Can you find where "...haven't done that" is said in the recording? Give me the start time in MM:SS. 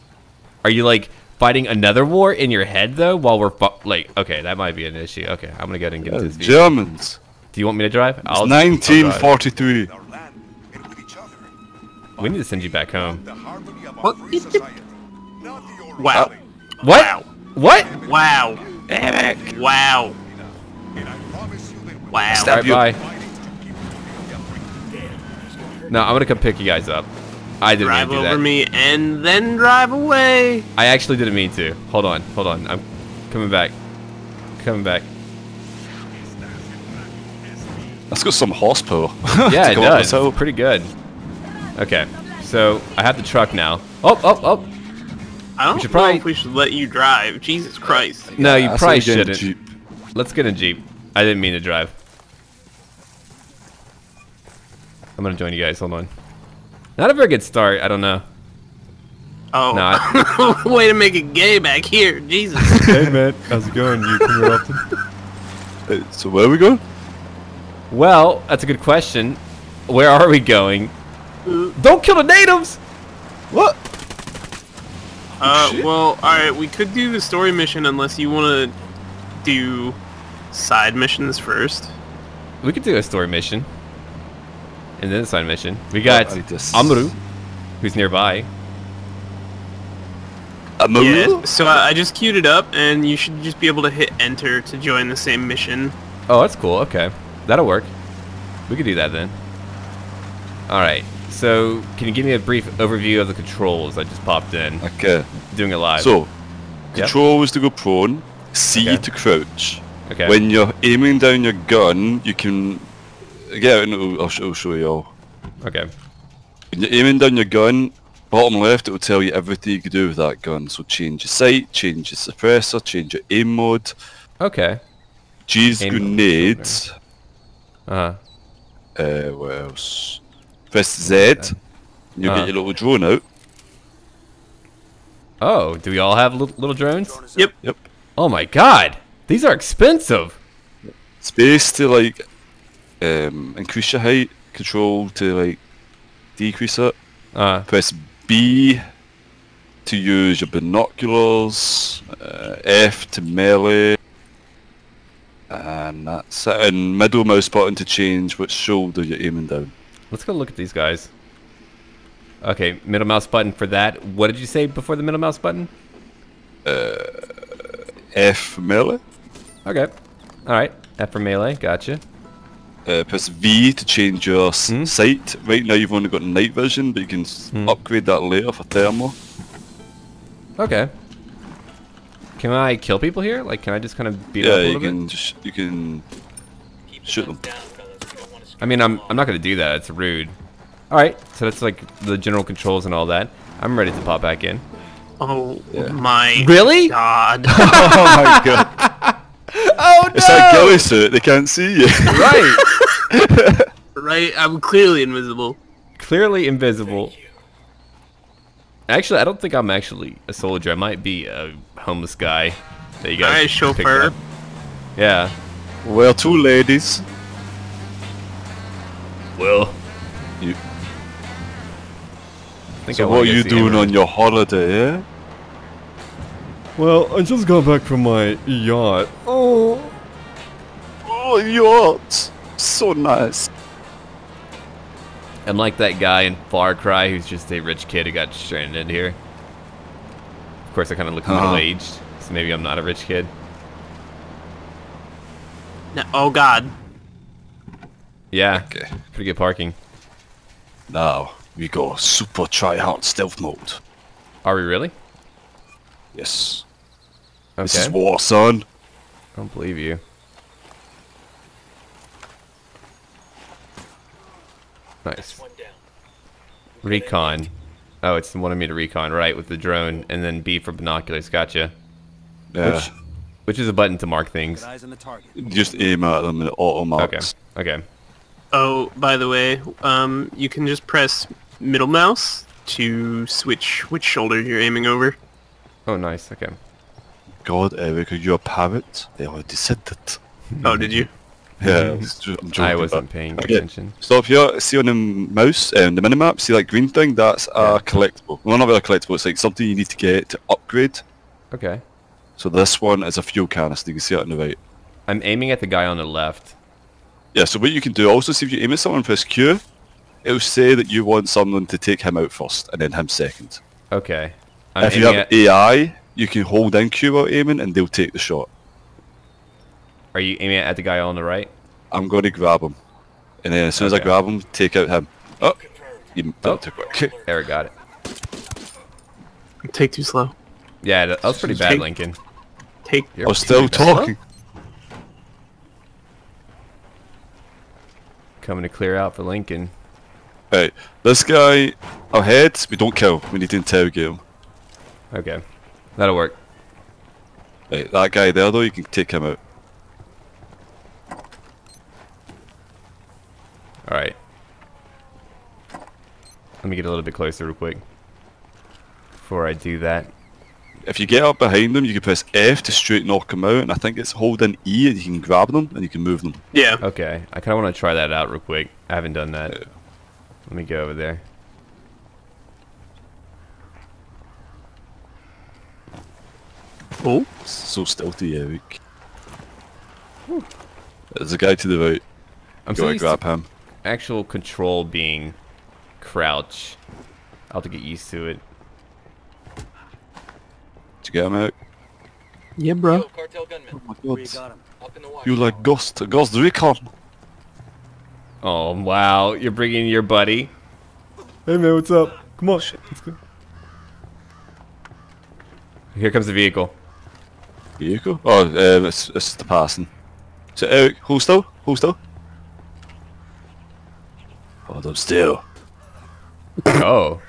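06:08.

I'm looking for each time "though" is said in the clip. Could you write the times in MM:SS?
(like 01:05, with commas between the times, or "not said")
00:02, 05:48.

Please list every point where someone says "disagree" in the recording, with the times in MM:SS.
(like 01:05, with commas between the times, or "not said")
not said.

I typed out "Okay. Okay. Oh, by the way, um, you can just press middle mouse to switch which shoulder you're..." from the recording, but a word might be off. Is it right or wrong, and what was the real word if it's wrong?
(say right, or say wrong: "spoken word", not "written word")
right.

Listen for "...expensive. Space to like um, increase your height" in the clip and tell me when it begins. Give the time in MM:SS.
02:19.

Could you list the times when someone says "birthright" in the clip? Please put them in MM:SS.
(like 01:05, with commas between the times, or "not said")
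not said.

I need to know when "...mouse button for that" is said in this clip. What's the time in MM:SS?
02:43.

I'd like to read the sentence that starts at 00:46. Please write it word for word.
if we should let you drive.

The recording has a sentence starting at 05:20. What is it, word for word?
Are you aiming at the guy on the right?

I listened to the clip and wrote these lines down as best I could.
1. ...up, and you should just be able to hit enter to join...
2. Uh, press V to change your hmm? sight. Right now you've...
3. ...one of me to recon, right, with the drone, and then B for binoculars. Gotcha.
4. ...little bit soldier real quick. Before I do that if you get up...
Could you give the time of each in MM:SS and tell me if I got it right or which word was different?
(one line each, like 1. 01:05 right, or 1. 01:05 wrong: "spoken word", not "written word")
1. 01:32 right
2. 02:52 right
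3. 04:28 right
4. 05:56 wrong: "closer", not "soldier".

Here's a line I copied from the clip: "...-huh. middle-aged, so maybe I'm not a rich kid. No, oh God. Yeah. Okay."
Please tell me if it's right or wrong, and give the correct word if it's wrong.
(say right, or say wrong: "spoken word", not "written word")
right.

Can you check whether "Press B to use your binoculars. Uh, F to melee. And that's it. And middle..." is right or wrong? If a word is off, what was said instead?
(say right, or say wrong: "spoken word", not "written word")
right.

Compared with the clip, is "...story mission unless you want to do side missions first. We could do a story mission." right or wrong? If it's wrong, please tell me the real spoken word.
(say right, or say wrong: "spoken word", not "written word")
right.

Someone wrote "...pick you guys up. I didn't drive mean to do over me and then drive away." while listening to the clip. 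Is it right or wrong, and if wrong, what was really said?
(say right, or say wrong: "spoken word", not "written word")
right.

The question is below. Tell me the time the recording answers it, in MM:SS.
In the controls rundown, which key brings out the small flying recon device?
02:10.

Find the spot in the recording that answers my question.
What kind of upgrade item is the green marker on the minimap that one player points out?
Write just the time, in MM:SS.
05:03.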